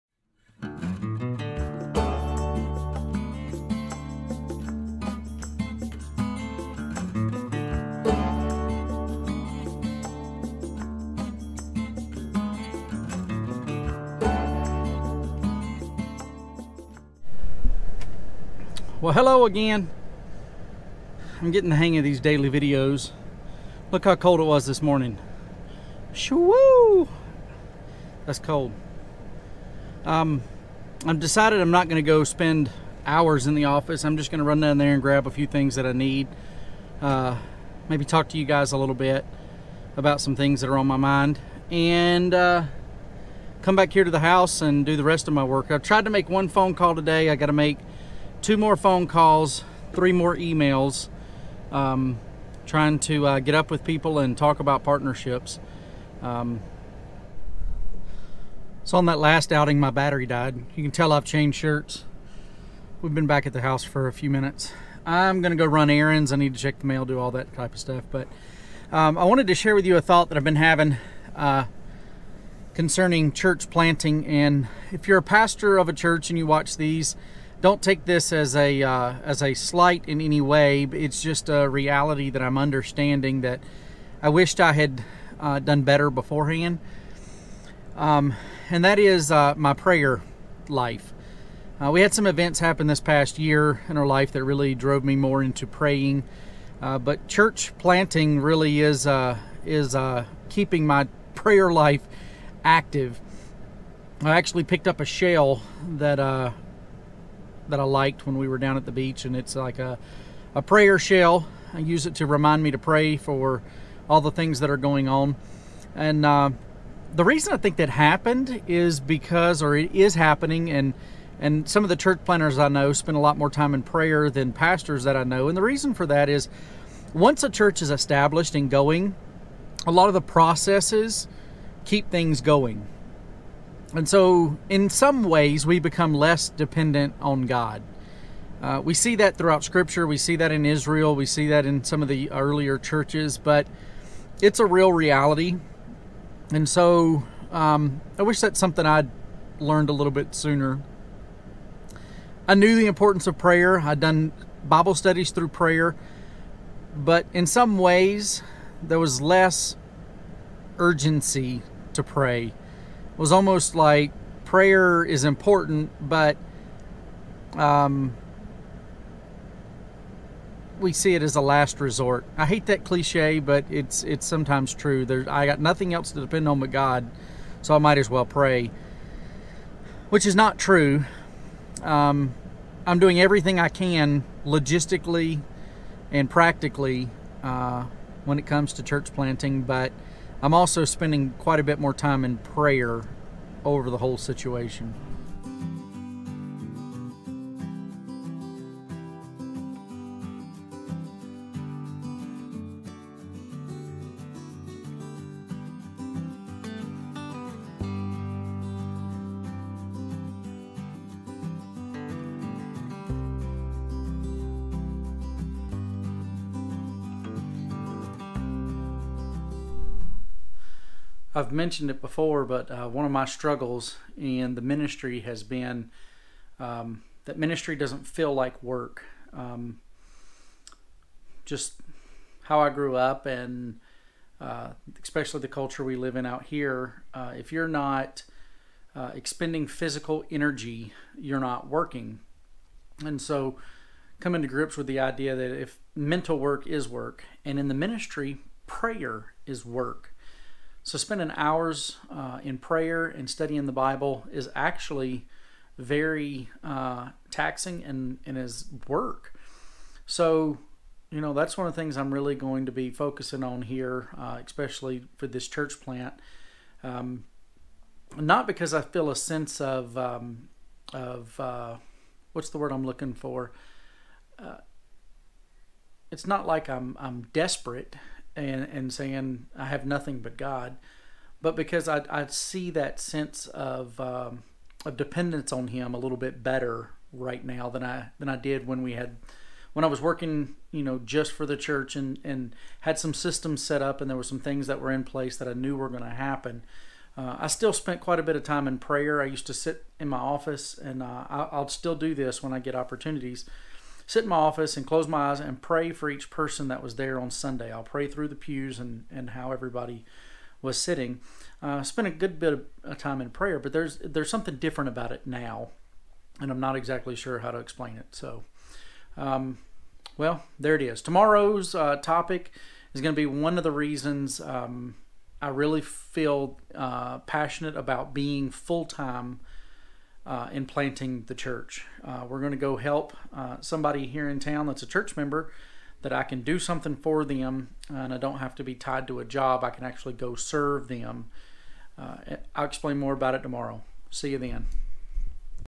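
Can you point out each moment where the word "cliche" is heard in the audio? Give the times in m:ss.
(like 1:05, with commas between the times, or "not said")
2:52.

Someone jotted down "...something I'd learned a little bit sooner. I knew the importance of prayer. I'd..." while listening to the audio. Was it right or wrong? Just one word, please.
right.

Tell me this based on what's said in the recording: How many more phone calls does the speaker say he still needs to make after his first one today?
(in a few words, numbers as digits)
2.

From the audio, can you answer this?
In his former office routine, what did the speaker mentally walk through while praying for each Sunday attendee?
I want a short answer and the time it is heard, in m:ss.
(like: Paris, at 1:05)
The pews, at 5:08.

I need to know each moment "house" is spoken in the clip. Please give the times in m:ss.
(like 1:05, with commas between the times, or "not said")
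0:44, 1:03.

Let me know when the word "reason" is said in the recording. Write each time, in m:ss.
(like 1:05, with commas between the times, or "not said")
1:57, 2:05, 5:23.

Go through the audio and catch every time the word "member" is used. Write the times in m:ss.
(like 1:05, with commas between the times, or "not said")
5:35.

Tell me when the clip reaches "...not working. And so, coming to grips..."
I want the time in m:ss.
4:01.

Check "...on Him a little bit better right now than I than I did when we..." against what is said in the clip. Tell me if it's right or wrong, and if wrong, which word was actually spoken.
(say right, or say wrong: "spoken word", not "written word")
right.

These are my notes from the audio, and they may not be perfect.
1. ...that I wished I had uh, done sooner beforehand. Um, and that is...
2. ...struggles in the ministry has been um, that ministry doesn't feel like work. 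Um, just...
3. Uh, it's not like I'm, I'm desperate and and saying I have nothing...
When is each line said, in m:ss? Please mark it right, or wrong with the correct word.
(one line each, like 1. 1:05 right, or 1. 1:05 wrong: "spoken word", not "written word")
1. 1:23 wrong: "better", not "sooner"
2. 3:43 right
3. 4:34 right.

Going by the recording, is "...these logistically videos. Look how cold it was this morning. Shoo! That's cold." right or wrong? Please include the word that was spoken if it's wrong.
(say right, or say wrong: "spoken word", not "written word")
wrong: "daily", not "logistically".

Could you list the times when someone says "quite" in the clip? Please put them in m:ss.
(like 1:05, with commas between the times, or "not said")
3:11, 4:57.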